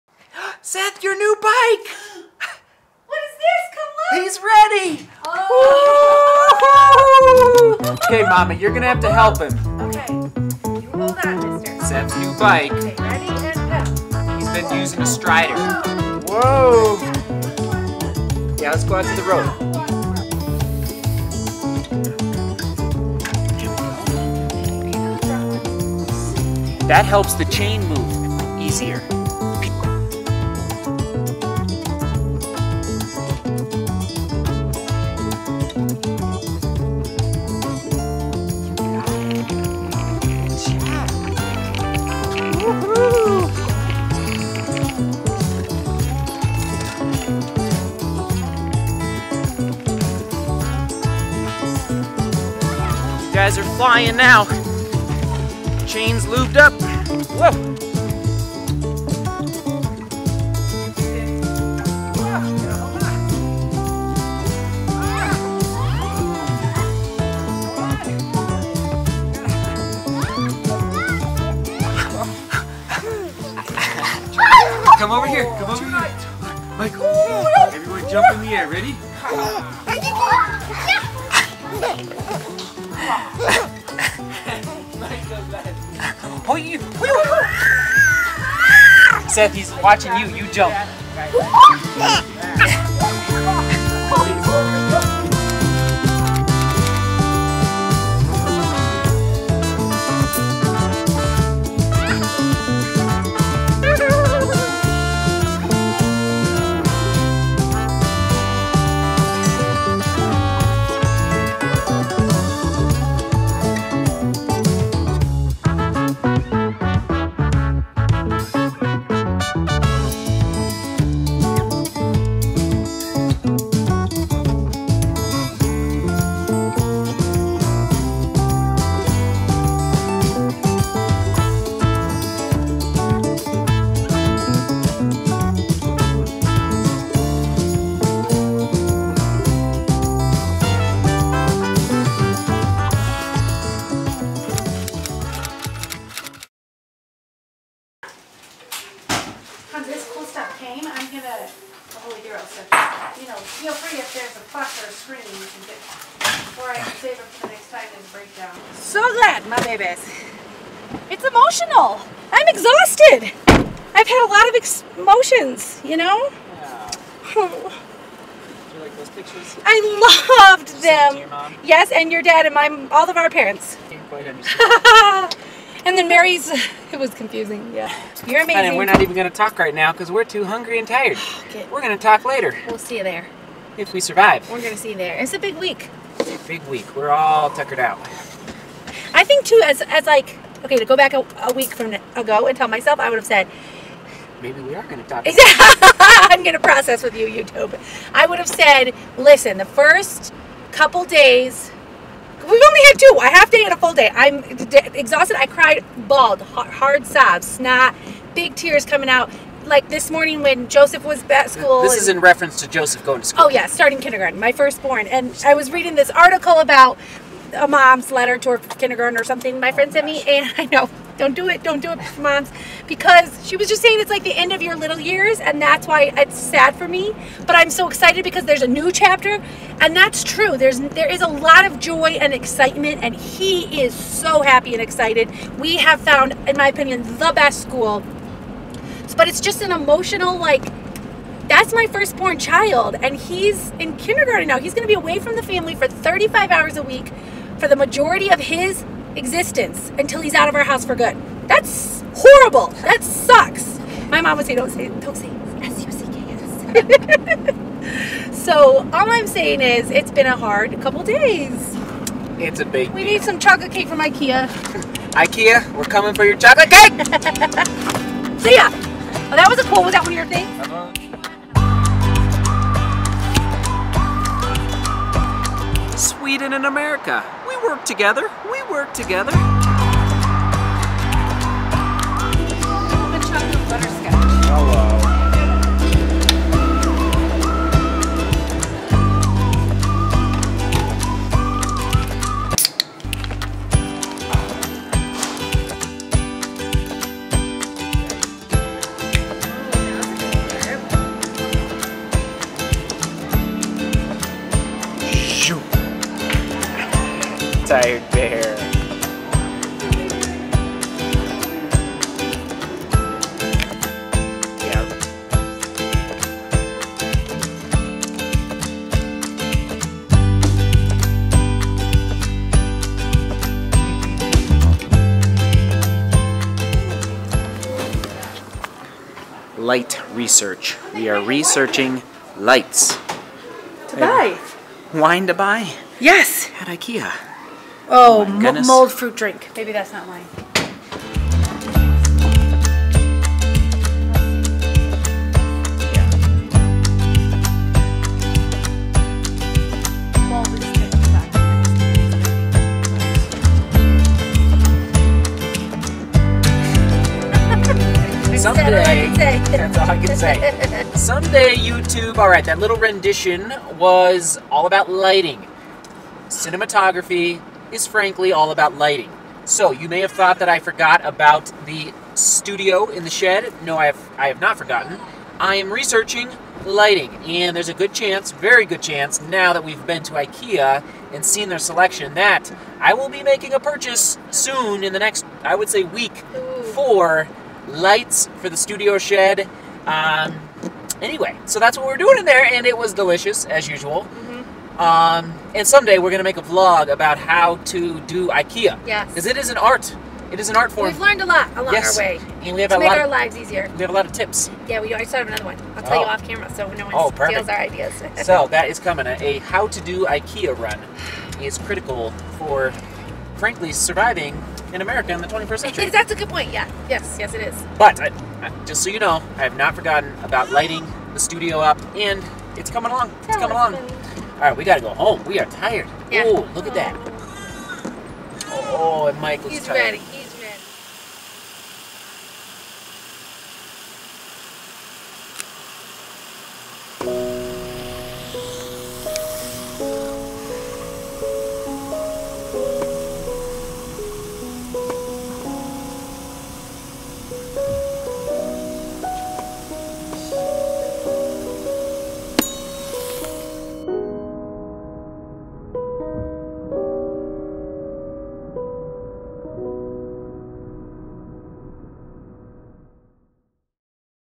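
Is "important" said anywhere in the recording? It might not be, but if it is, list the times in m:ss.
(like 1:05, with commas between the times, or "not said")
not said.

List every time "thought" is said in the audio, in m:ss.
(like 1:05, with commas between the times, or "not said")
6:10.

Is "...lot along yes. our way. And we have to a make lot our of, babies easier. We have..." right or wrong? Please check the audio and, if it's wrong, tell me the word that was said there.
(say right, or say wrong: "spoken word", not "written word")
wrong: "lives", not "babies".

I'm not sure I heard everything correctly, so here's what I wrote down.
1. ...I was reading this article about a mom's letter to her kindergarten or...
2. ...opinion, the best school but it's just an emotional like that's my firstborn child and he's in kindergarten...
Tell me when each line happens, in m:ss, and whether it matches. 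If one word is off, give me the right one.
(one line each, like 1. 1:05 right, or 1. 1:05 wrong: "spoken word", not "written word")
1. 3:35 right
2. 3:56 right.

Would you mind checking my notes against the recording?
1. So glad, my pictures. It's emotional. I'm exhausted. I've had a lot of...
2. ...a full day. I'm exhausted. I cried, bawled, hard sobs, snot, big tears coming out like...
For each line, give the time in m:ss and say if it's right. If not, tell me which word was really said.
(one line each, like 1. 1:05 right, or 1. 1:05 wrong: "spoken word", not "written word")
1. 2:38 wrong: "babies", not "pictures"
2. 3:23 right.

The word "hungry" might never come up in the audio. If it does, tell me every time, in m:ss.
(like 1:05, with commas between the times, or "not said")
3:00.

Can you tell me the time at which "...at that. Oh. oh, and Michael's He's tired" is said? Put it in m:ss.
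7:06.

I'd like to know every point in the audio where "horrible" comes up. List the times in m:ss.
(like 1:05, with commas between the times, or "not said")
4:12.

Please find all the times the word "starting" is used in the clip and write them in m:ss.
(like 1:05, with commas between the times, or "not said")
3:33.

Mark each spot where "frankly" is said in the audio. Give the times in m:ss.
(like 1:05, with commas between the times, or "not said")
6:07, 6:53.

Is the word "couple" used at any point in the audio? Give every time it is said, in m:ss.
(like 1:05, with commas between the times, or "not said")
3:20, 4:20.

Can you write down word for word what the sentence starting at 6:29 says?
Um, anyway, so that's what we're doing in there, and it was delicious as usual.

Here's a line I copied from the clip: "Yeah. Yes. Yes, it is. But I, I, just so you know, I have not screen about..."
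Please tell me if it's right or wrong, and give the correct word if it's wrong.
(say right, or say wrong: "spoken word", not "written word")
wrong: "forgotten", not "screen".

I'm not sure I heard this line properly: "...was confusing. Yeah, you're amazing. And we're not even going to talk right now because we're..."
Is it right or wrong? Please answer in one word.
right.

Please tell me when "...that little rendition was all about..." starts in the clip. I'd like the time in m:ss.
6:02.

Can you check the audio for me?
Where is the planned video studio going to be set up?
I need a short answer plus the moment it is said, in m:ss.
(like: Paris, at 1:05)
the shed, at 6:12.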